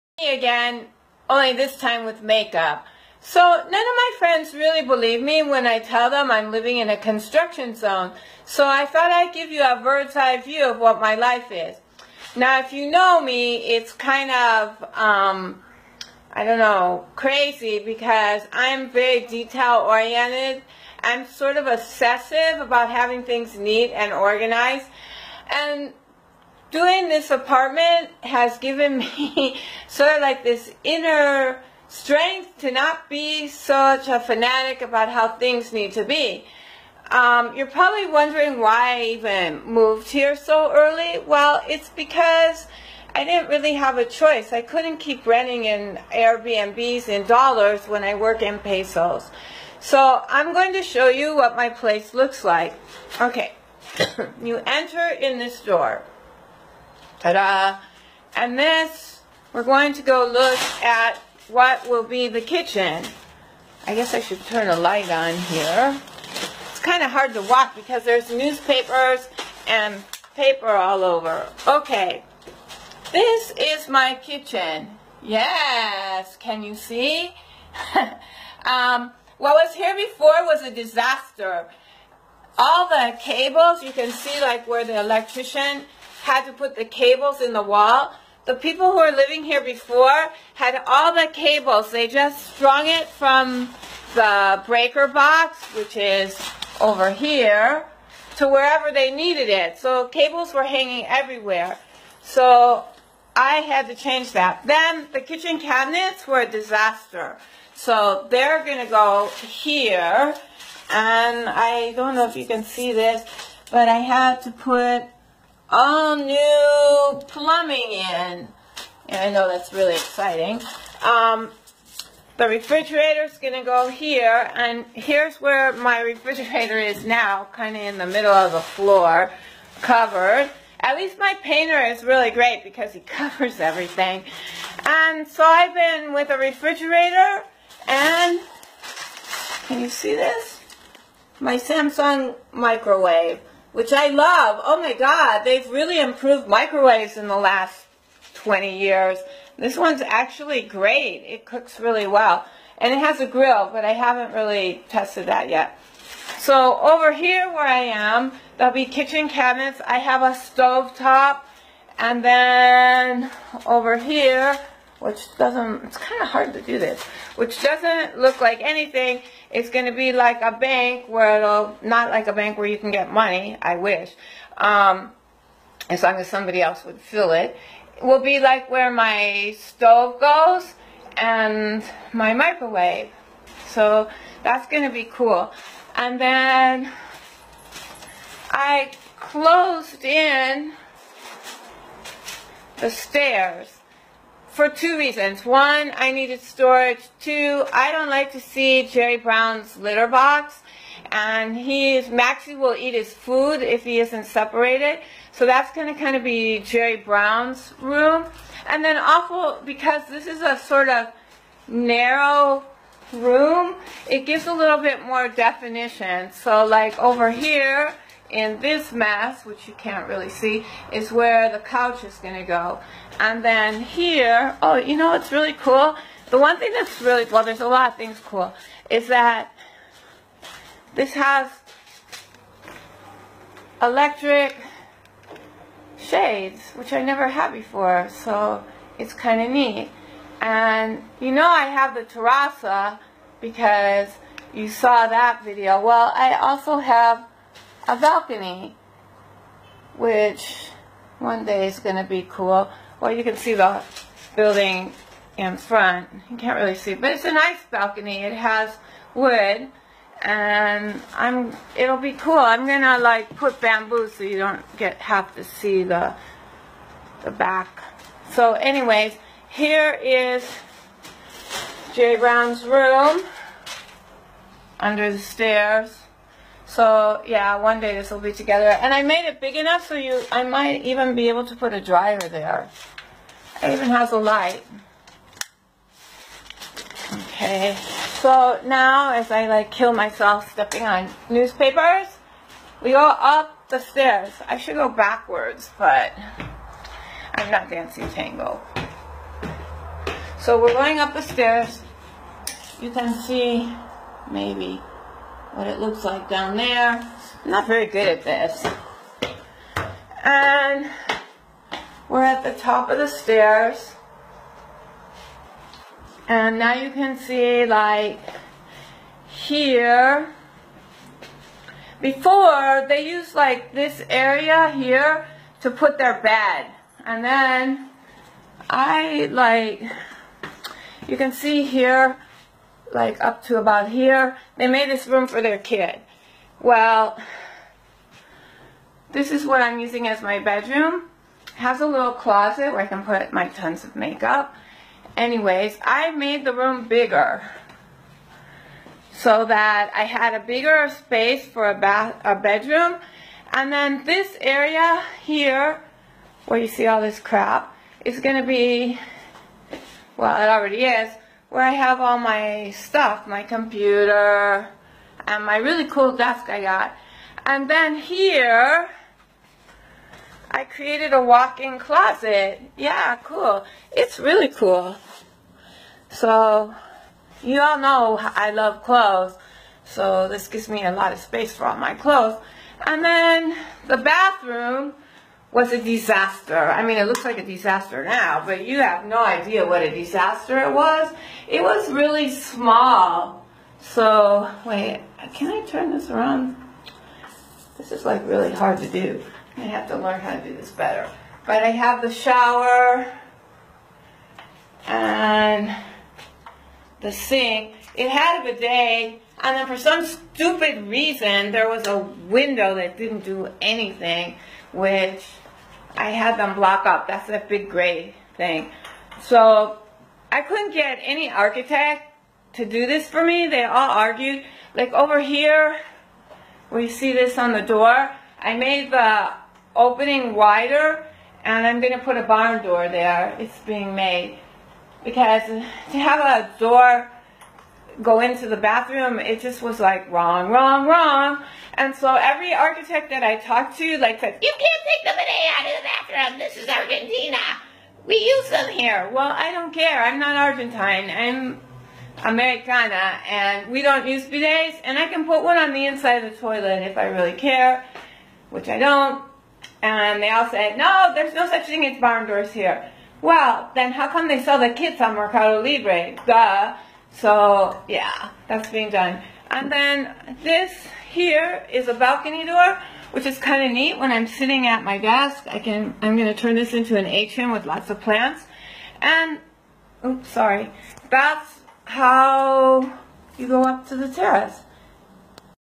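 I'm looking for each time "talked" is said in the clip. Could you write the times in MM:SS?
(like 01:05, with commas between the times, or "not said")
07:23.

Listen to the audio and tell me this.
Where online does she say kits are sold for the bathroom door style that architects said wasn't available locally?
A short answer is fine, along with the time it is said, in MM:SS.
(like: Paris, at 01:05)
Mercado Libre, at 07:45.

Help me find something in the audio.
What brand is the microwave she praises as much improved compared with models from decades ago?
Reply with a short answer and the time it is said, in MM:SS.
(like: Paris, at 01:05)
Samsung, at 02:21.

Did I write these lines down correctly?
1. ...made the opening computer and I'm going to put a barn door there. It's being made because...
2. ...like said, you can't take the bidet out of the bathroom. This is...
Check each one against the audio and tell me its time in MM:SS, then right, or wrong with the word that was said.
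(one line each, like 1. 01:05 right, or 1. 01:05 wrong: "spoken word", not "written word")
1. 07:08 wrong: "wider", not "computer"
2. 07:23 right.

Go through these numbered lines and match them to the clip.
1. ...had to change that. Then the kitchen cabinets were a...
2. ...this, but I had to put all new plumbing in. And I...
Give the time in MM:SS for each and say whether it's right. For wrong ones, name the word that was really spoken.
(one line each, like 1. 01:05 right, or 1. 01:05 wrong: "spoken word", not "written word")
1. 01:43 right
2. 01:52 right.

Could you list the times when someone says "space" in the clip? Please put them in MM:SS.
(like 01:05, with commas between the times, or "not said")
05:50, 06:21.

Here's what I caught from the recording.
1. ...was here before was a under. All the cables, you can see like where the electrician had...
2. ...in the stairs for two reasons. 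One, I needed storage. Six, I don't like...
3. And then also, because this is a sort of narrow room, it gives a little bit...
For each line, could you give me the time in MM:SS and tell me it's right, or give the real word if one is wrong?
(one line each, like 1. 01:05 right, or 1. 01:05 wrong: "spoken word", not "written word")
1. 01:19 wrong: "disaster", not "under"
2. 03:10 wrong: "Two", not "Six"
3. 03:28 right.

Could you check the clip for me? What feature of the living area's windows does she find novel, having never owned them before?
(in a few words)
electric shades.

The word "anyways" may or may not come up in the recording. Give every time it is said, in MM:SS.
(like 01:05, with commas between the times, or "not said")
04:28, 05:45.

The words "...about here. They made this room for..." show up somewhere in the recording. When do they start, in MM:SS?
05:33.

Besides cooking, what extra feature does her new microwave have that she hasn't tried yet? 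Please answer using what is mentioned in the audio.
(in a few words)
a grill.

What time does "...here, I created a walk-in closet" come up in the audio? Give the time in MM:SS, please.
06:07.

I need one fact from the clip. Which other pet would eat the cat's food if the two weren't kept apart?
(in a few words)
Maxie.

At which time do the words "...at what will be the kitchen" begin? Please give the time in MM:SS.
01:00.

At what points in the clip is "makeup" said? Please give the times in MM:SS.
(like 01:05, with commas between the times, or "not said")
00:02, 05:43.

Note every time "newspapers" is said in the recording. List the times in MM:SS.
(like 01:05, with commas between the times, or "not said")
01:08, 04:51.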